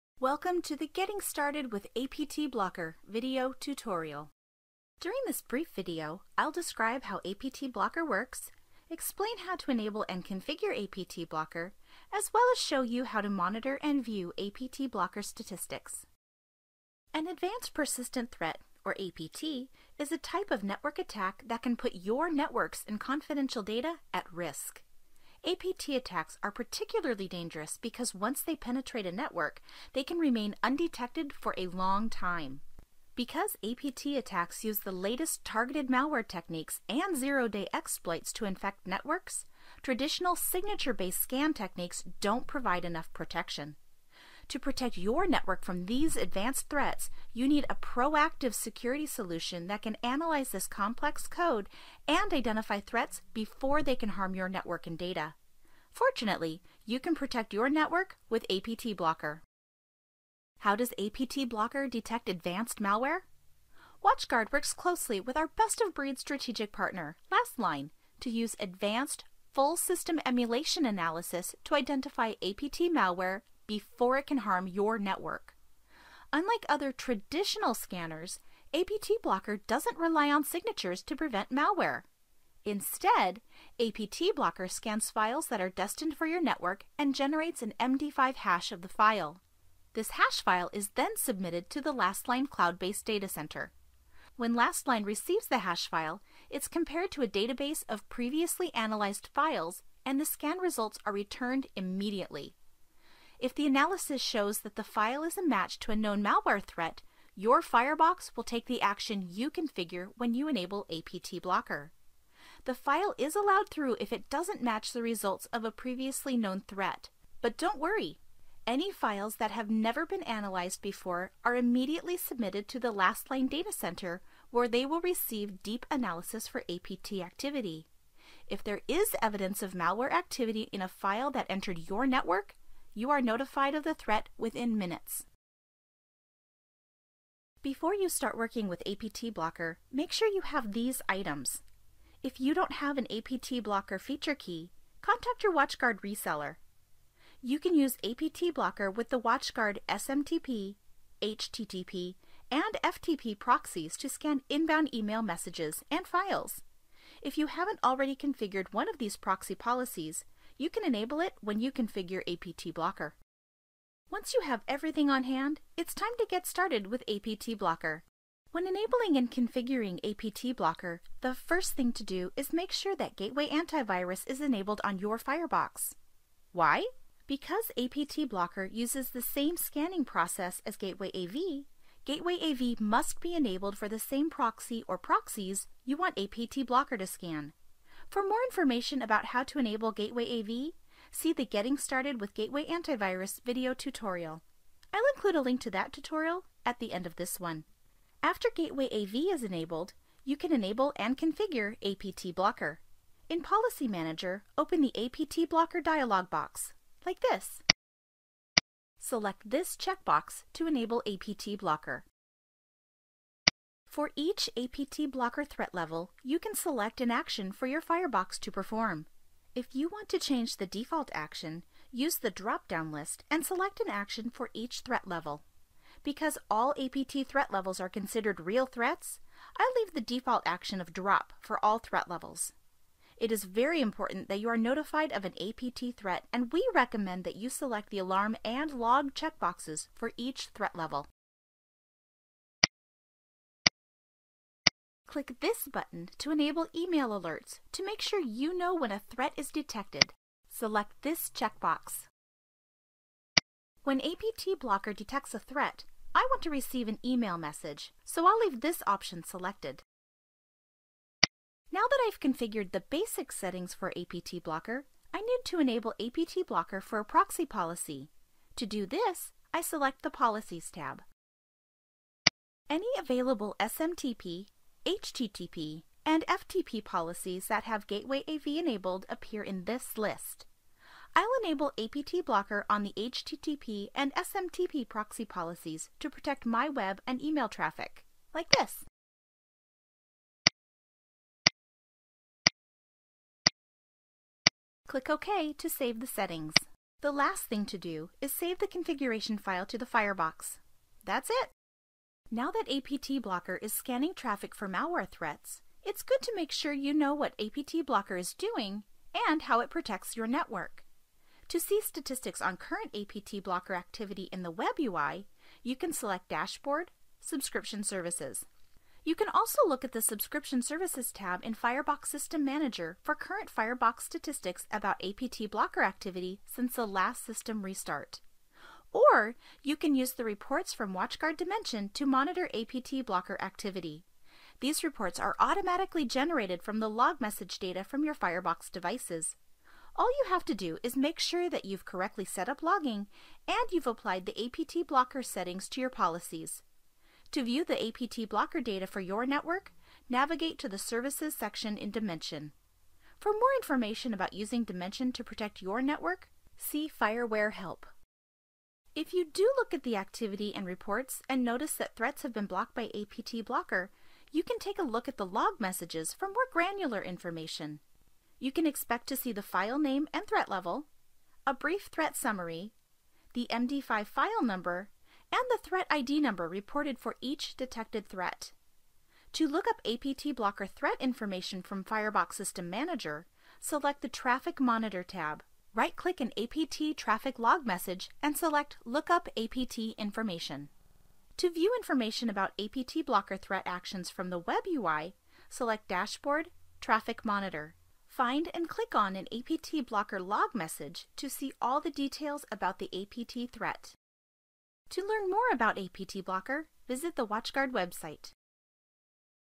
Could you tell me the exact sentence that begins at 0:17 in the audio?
An Advanced Persistent Threat, or APT, is a type of network attack that can put your networks and confidential data at risk.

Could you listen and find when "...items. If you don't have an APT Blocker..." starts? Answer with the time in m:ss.
2:21.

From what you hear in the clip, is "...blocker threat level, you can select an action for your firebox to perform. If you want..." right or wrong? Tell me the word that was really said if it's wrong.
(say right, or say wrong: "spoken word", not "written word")
right.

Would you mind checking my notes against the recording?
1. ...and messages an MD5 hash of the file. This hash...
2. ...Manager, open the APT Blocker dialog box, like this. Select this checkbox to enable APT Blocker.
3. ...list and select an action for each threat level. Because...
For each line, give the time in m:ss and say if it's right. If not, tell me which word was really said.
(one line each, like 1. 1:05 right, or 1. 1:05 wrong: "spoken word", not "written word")
1. 1:26 wrong: "generates", not "messages"
2. 3:23 right
3. 3:42 right.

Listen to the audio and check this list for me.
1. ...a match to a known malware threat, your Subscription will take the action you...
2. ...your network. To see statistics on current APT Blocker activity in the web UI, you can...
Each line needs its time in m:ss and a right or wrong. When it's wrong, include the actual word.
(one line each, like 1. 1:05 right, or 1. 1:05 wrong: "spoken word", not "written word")
1. 1:45 wrong: "Firebox", not "Subscription"
2. 5:10 right.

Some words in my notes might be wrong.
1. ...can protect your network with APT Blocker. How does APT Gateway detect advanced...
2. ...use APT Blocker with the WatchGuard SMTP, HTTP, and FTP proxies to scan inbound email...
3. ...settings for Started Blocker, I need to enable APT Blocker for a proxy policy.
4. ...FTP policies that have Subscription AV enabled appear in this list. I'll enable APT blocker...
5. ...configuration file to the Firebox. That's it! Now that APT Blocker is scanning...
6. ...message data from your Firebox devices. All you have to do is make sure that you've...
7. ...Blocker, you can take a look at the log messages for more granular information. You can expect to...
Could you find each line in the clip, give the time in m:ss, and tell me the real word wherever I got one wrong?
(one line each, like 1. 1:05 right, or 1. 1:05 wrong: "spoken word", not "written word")
1. 0:56 wrong: "Blocker", not "Gateway"
2. 2:27 right
3. 4:23 wrong: "APT", not "Started"
4. 4:36 wrong: "Gateway", not "Subscription"
5. 4:58 right
6. 5:37 right
7. 6:03 right.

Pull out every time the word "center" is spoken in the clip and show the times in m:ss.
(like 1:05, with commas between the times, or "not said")
1:33, 2:03.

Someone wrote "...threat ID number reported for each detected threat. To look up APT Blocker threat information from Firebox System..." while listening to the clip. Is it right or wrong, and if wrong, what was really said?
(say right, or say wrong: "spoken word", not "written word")
right.